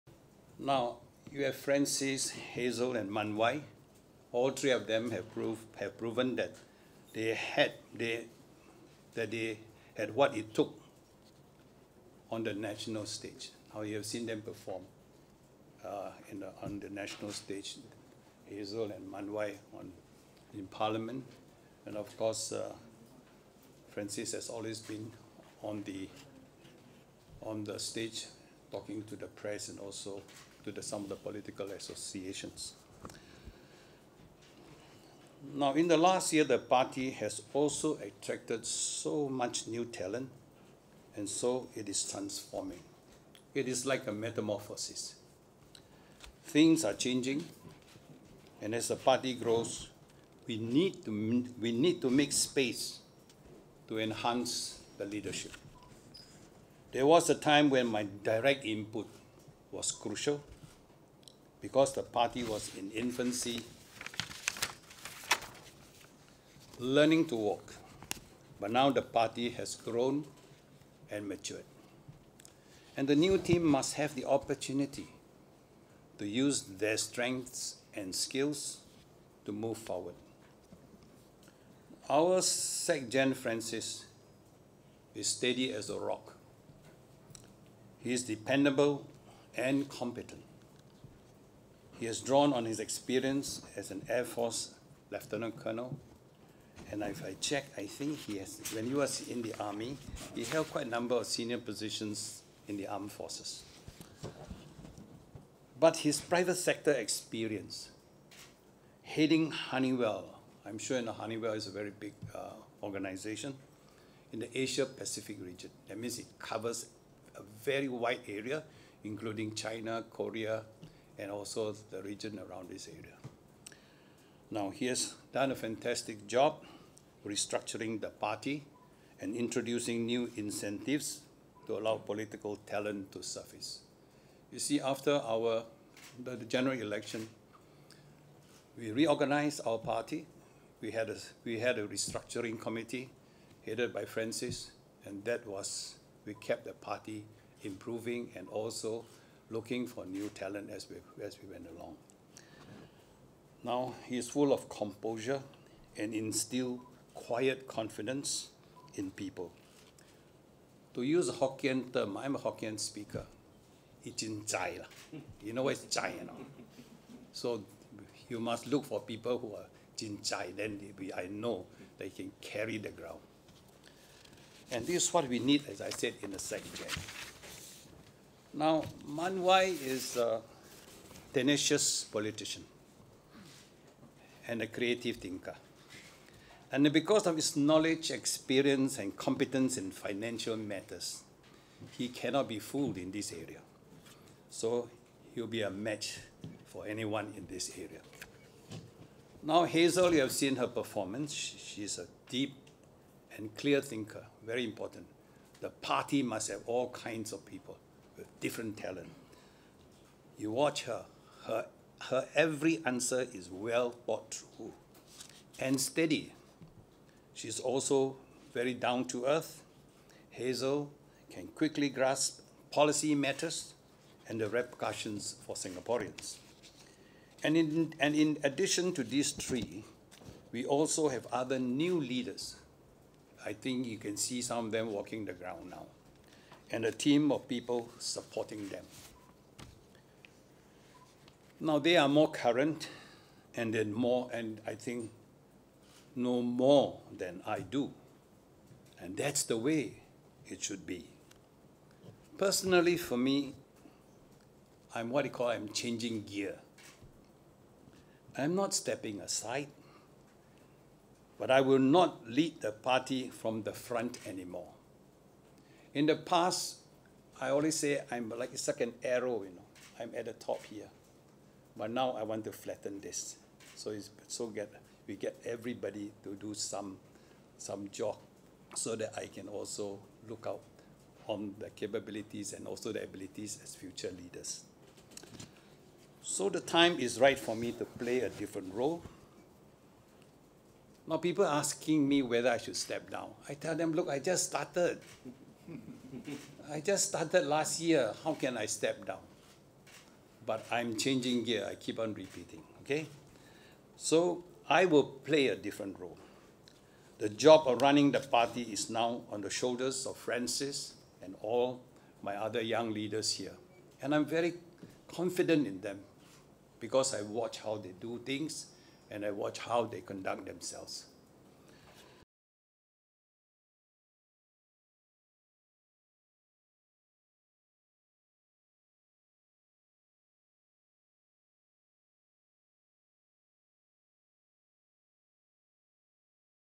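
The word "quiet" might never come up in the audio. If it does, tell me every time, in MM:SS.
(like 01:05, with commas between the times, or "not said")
02:37.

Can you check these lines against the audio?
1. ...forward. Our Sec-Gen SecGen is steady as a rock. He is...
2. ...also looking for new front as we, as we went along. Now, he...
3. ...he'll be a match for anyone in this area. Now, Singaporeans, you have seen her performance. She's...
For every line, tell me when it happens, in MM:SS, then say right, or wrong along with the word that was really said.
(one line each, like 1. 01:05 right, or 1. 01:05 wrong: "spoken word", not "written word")
1. 01:19 wrong: "Francis", not "SecGen"
2. 02:28 wrong: "talent", not "front"
3. 03:15 wrong: "Hazel", not "Singaporeans".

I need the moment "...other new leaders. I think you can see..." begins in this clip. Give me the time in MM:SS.
03:51.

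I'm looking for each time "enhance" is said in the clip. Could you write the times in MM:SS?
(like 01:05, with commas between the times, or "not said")
00:53.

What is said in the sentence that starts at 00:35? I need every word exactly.
Now, in the last year, the party has also attracted so much new talent, and so it is transforming.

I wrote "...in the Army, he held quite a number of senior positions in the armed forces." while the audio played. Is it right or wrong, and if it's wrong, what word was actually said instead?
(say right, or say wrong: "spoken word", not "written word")
right.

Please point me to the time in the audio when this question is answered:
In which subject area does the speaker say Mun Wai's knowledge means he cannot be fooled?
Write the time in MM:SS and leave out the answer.
03:09.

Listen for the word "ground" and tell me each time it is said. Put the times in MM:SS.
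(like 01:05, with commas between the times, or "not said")
02:52, 03:55.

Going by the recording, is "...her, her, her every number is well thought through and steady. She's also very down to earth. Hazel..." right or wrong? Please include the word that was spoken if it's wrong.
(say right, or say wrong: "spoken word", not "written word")
wrong: "answer", not "number".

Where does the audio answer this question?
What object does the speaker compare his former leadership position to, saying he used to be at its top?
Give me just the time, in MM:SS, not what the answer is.
04:28.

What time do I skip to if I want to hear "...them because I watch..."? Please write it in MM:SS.
05:15.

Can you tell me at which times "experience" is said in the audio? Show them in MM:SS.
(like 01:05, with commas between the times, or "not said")
01:32, 01:46, 03:08.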